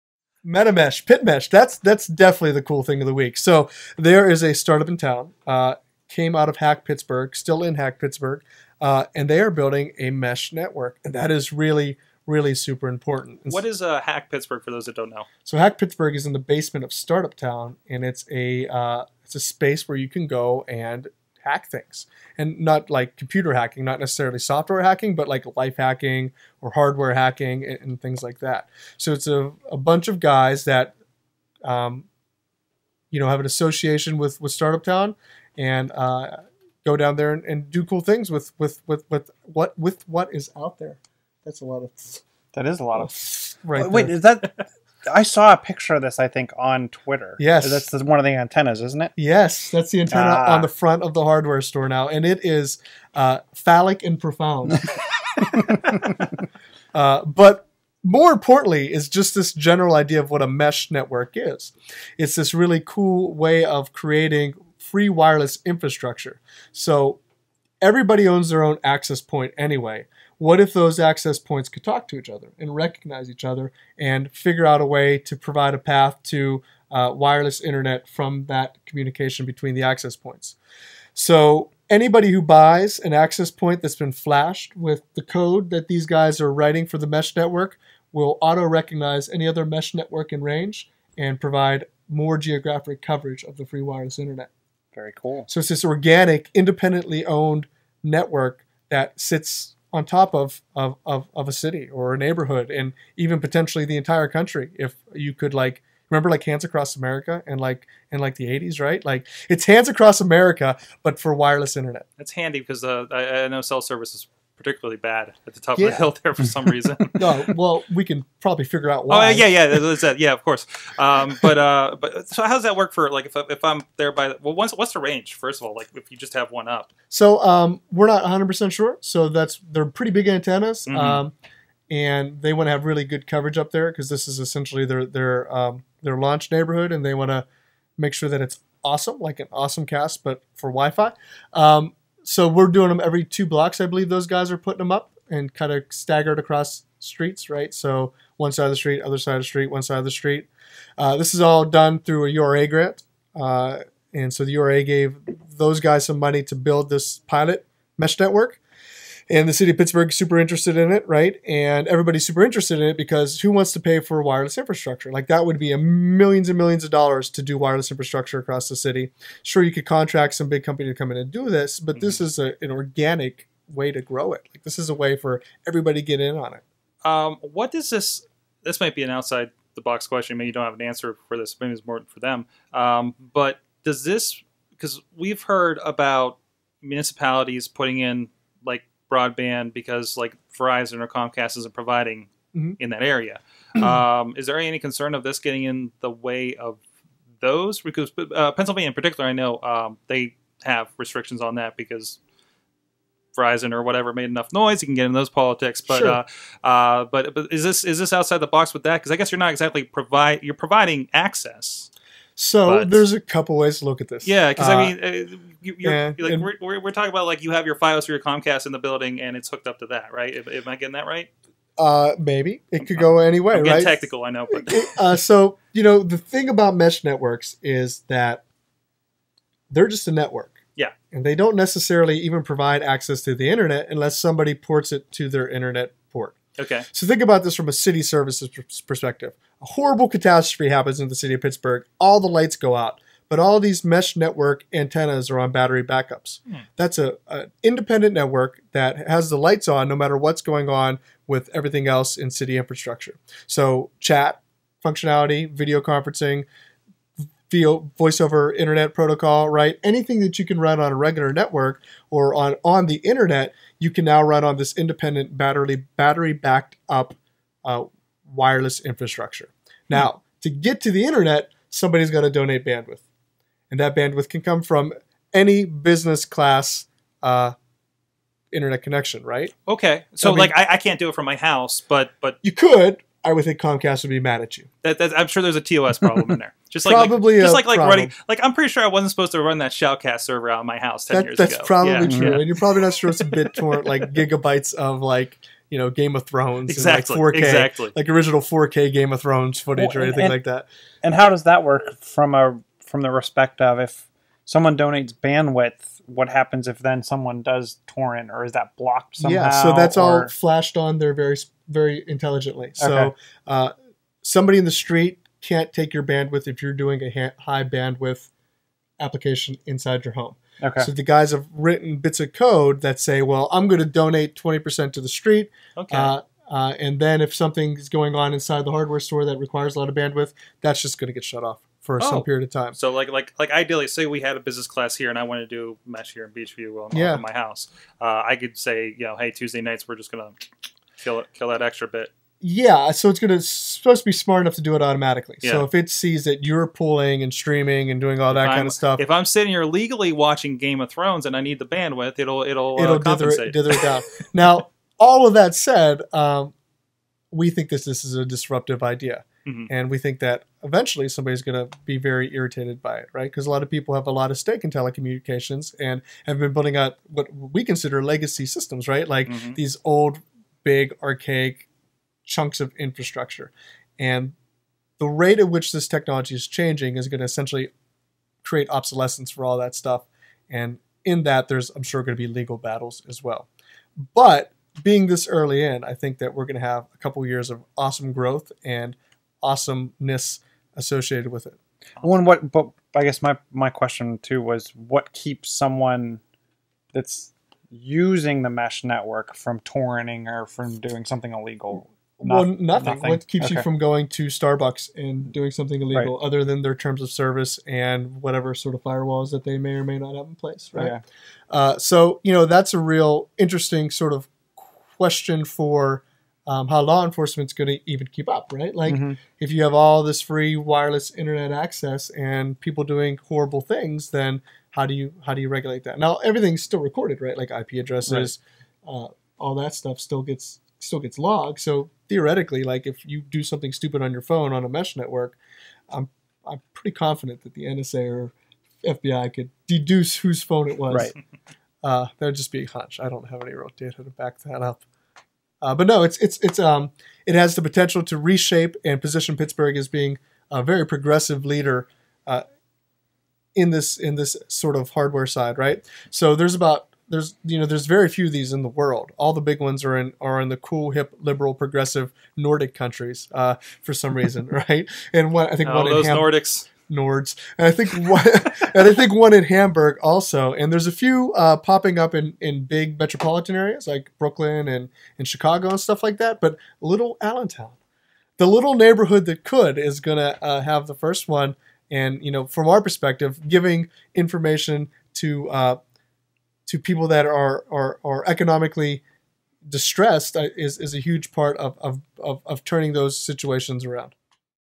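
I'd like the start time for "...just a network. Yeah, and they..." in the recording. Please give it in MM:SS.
03:49.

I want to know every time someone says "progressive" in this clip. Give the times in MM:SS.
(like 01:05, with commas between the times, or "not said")
07:30, 07:41.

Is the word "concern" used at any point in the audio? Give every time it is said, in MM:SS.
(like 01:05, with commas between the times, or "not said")
03:14.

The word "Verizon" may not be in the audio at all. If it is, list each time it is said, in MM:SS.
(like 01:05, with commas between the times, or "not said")
03:10, 03:23.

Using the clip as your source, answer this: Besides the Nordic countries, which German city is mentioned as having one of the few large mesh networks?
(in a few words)
Hamburg.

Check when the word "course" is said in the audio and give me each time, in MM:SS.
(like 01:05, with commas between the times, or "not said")
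02:00.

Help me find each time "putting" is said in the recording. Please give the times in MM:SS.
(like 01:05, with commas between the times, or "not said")
02:24, 03:07.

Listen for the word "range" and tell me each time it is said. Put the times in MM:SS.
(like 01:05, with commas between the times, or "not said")
01:30, 02:04.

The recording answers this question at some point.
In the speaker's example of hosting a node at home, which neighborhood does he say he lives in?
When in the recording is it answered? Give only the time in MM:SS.
05:36.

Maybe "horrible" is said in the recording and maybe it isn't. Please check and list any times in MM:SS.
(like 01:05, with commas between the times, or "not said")
03:59, 07:03.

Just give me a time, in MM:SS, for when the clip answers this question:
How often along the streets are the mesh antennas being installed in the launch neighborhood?
02:23.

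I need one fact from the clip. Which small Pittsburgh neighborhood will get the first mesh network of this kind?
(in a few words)
Allentown.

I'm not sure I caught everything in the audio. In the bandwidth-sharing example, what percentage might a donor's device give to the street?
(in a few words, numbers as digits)
20%.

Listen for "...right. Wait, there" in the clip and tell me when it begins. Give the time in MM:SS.
00:43.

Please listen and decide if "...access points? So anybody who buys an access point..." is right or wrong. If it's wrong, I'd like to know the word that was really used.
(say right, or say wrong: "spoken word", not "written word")
right.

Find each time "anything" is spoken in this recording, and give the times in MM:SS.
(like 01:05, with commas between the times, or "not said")
04:19, 05:00.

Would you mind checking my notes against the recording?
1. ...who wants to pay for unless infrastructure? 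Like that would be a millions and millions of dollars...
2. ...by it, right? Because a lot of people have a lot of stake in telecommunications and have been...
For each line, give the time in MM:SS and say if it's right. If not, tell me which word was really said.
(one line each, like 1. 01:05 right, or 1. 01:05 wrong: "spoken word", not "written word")
1. 02:43 wrong: "wireless", not "unless"
2. 06:02 right.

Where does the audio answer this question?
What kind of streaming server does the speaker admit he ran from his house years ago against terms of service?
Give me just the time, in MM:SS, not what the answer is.
04:49.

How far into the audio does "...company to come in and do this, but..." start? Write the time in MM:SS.
02:50.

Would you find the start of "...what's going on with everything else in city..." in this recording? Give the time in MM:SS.
04:10.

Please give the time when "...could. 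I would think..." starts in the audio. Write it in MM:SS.
04:42.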